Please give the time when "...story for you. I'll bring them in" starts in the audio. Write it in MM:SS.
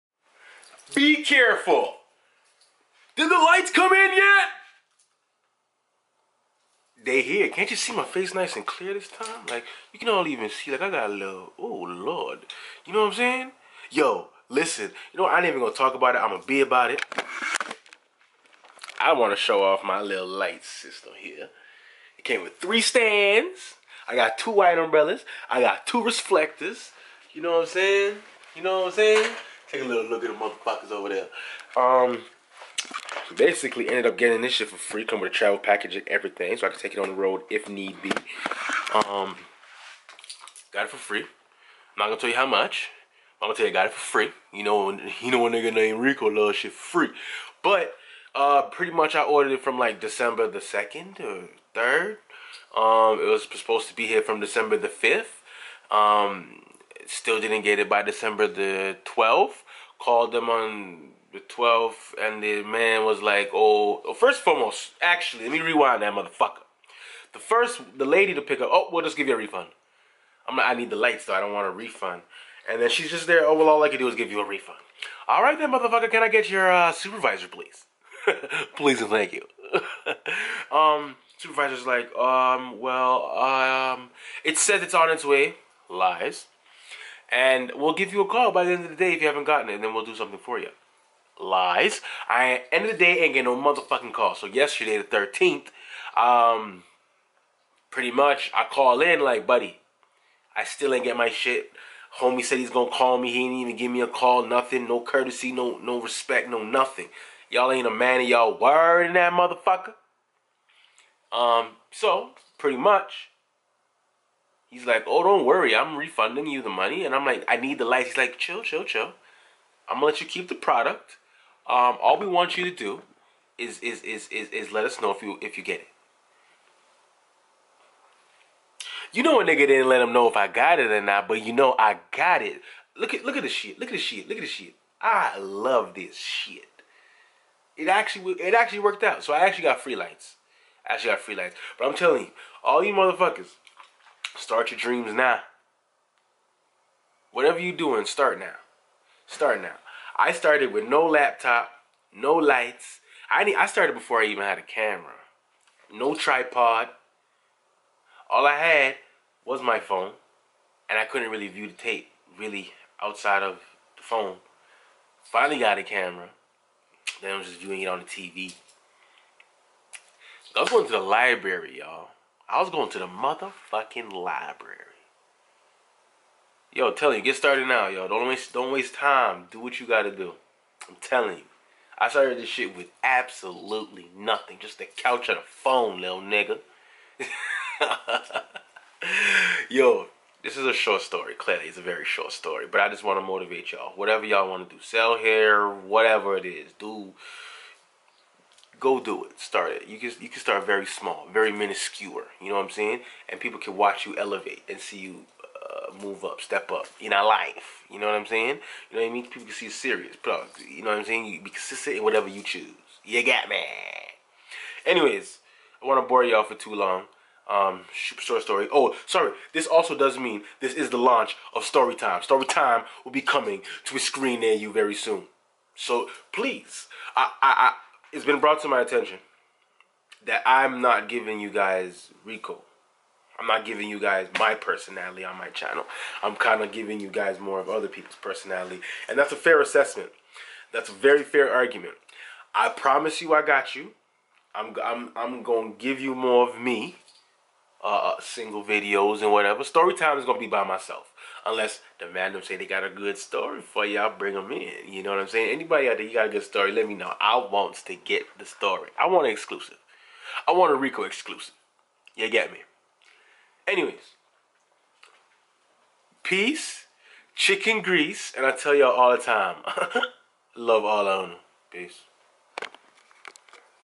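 04:13.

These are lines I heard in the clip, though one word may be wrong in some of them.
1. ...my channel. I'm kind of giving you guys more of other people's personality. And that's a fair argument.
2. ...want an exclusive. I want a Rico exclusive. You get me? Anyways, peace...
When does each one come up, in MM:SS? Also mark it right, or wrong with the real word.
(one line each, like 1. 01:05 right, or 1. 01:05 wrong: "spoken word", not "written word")
1. 03:55 wrong: "assessment", not "argument"
2. 04:19 right.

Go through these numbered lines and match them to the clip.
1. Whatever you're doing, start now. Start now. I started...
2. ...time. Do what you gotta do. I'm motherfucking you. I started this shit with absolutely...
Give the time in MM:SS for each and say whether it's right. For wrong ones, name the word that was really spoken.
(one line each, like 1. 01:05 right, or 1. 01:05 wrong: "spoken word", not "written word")
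1. 02:27 right
2. 02:58 wrong: "telling", not "motherfucking".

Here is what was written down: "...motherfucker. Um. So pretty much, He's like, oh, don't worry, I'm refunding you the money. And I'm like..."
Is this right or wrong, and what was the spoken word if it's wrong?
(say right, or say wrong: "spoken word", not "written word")
right.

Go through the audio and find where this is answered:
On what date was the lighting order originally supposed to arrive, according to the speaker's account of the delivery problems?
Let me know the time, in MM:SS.
00:54.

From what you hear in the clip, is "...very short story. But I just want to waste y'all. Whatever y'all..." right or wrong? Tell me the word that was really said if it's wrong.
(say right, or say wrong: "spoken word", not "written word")
wrong: "motivate", not "waste".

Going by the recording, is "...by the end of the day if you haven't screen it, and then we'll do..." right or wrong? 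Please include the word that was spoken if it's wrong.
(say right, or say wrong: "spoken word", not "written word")
wrong: "gotten", not "screen".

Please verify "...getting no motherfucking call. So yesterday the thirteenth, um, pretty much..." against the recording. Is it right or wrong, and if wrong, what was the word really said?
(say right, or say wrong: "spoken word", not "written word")
right.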